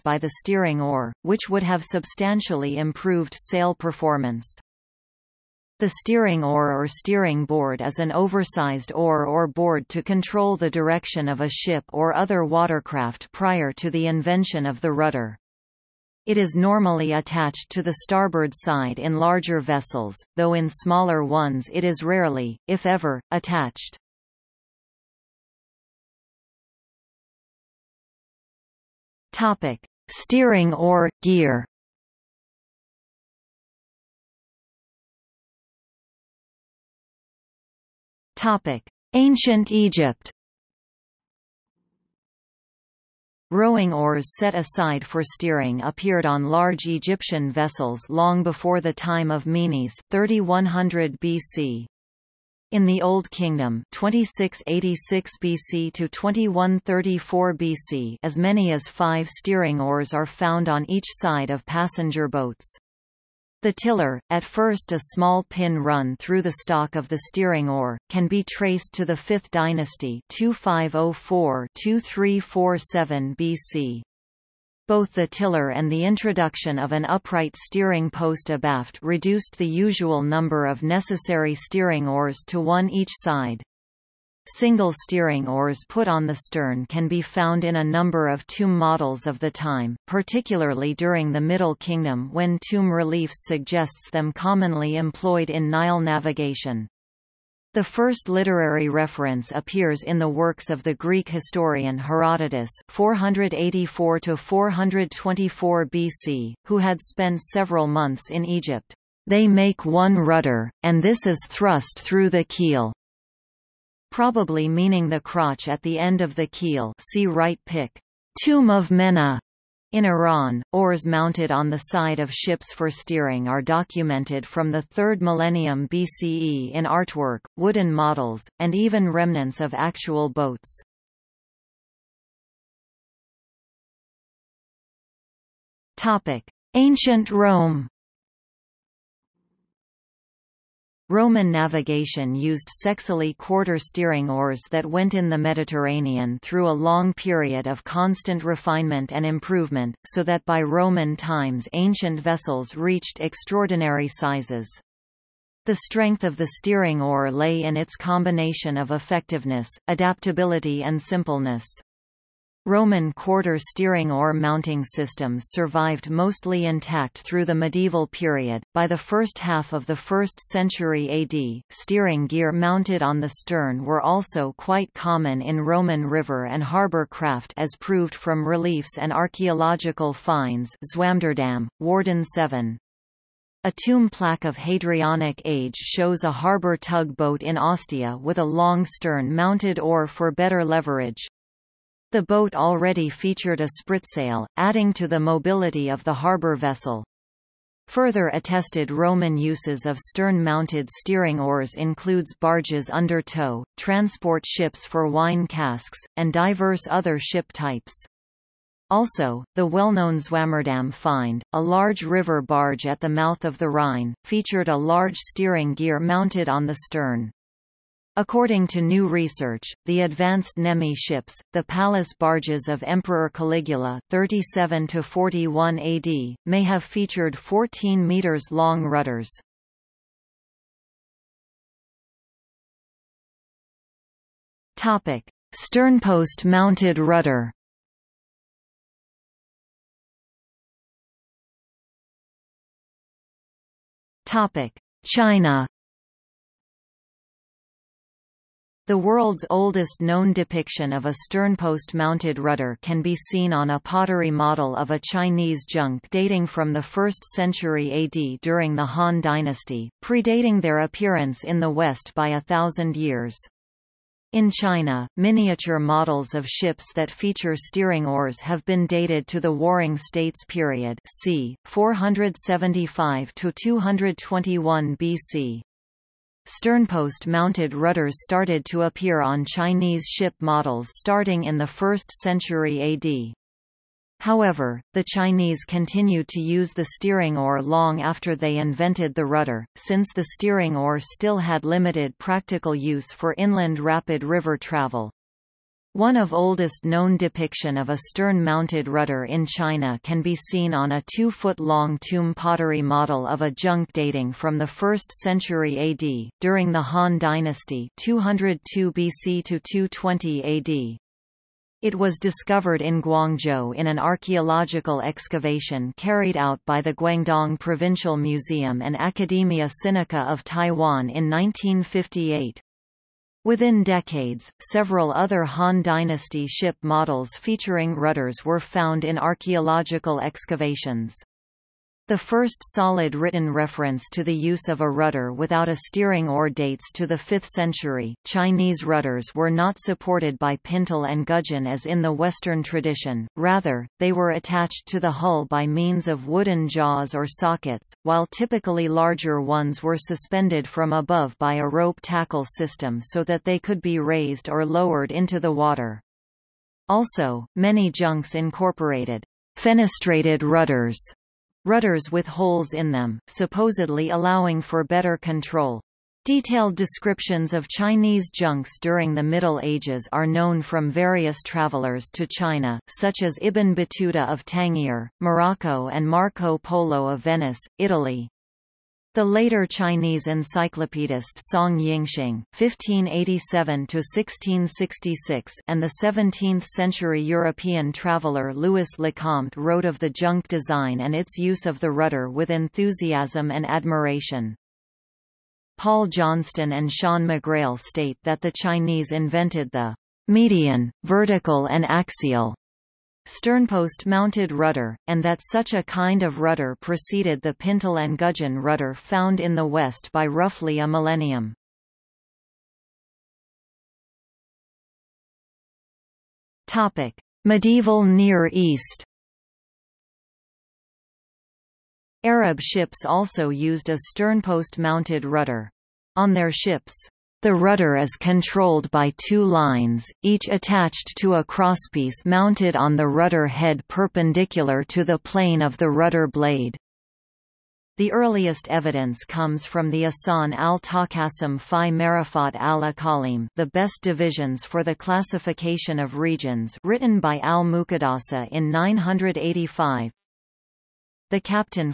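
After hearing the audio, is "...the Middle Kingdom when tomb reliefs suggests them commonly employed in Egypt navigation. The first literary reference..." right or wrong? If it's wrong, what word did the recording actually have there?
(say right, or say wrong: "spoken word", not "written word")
wrong: "Nile", not "Egypt".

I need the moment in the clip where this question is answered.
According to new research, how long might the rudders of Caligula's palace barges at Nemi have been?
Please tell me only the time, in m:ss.
3:47.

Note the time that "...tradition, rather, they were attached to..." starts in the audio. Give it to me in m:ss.
5:42.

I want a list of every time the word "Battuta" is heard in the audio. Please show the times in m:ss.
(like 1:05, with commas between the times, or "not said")
6:13.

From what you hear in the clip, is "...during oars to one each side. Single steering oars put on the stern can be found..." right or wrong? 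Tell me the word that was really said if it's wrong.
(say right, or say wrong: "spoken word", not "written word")
wrong: "steering", not "during".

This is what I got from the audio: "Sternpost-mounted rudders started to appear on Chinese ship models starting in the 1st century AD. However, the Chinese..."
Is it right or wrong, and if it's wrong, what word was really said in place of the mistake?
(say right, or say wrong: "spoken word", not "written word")
right.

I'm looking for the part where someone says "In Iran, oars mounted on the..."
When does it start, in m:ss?
1:59.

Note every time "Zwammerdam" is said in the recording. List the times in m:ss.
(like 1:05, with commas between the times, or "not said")
3:00, 3:30.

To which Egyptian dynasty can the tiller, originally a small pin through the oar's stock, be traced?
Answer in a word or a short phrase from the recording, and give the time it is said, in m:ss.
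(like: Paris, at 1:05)
5th dynasty, at 1:09.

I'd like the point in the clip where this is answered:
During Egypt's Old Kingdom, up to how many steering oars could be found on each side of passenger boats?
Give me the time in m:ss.
0:58.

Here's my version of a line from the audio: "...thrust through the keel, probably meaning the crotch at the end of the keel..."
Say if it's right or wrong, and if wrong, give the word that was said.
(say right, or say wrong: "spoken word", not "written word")
right.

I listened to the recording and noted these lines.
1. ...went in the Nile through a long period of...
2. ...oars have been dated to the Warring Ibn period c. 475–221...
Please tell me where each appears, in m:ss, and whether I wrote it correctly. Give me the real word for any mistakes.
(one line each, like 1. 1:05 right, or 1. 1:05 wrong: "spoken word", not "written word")
1. 2:24 wrong: "Mediterranean", not "Nile"
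2. 4:28 wrong: "States", not "Ibn".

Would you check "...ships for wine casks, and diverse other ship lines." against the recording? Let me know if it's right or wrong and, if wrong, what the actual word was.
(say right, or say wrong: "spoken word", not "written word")
wrong: "types", not "lines".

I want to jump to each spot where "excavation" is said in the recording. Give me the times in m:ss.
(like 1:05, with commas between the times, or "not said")
5:15, 5:30.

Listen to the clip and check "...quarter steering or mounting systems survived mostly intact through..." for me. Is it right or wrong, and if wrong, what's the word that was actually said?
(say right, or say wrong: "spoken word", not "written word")
right.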